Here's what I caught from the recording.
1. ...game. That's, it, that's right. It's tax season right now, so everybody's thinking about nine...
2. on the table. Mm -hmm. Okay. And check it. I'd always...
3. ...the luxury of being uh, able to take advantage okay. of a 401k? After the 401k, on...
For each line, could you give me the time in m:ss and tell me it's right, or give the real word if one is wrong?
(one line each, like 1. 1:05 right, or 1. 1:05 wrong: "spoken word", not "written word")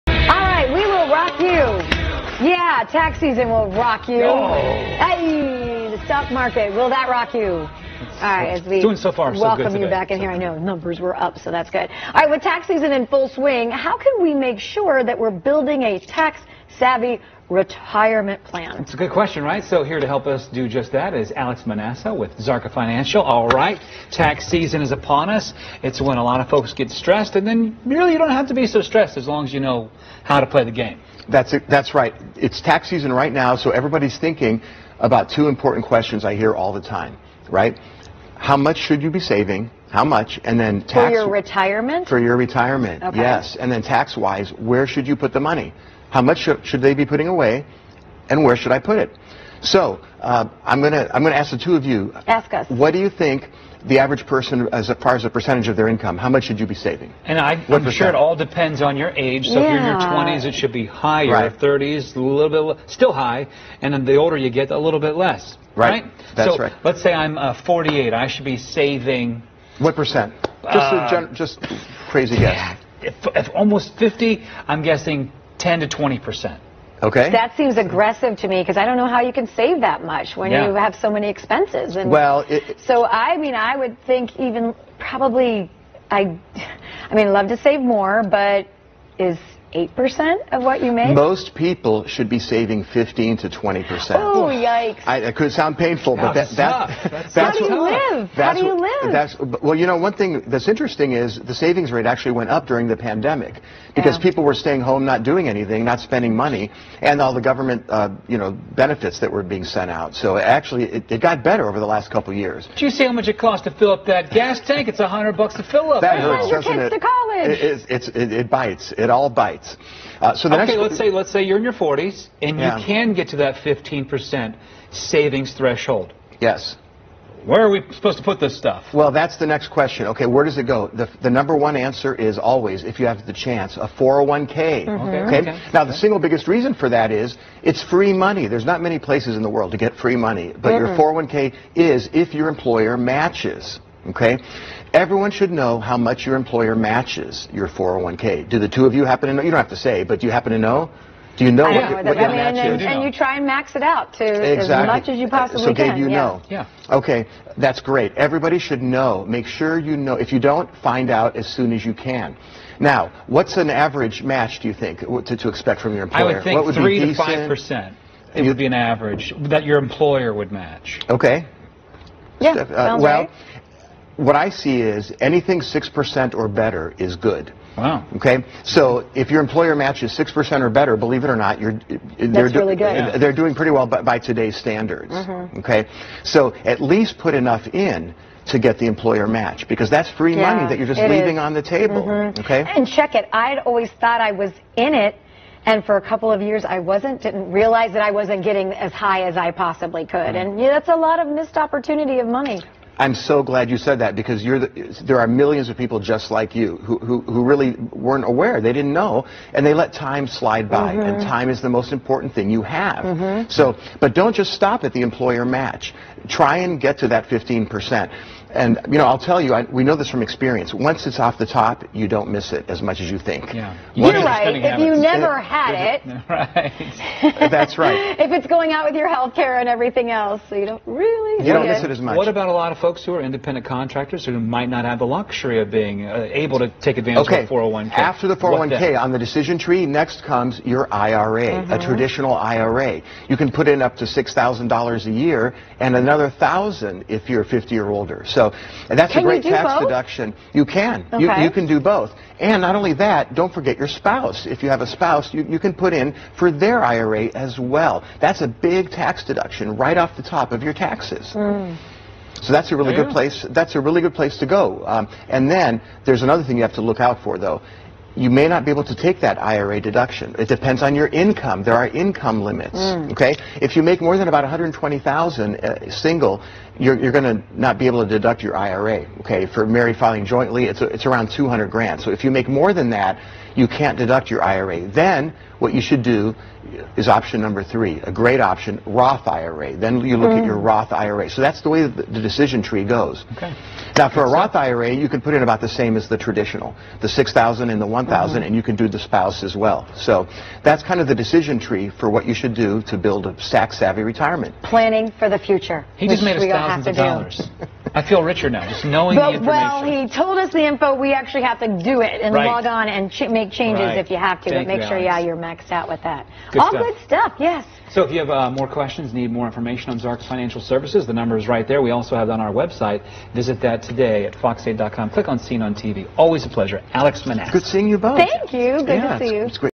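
1. 0:30 wrong: "two", not "nine"
2. 3:11 right
3. 3:54 right.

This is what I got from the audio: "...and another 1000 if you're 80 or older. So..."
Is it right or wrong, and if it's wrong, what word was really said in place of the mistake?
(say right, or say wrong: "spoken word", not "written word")
wrong: "50", not "80".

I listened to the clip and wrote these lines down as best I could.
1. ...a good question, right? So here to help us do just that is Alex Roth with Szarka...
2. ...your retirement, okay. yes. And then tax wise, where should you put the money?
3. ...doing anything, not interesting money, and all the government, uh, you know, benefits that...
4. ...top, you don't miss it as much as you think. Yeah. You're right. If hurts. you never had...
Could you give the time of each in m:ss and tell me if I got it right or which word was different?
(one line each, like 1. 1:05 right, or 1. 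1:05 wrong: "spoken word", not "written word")
1. 0:18 wrong: "Menassa", not "Roth"
2. 0:42 right
3. 1:45 wrong: "spending", not "interesting"
4. 3:41 wrong: "habits", not "hurts".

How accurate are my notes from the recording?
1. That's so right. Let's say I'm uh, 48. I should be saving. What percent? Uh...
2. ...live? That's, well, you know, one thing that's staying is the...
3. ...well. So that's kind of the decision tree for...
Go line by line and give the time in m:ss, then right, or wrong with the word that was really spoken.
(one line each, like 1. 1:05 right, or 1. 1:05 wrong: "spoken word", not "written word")
1. 1:06 right
2. 1:38 wrong: "interesting", not "staying"
3. 4:59 right.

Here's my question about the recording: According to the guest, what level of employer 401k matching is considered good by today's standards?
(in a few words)
6% or better.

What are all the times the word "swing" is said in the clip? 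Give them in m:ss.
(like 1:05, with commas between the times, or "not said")
0:13.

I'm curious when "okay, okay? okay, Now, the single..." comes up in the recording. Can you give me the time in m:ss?
2:15.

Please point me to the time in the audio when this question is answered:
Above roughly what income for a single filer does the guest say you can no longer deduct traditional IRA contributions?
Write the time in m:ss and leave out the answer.
4:34.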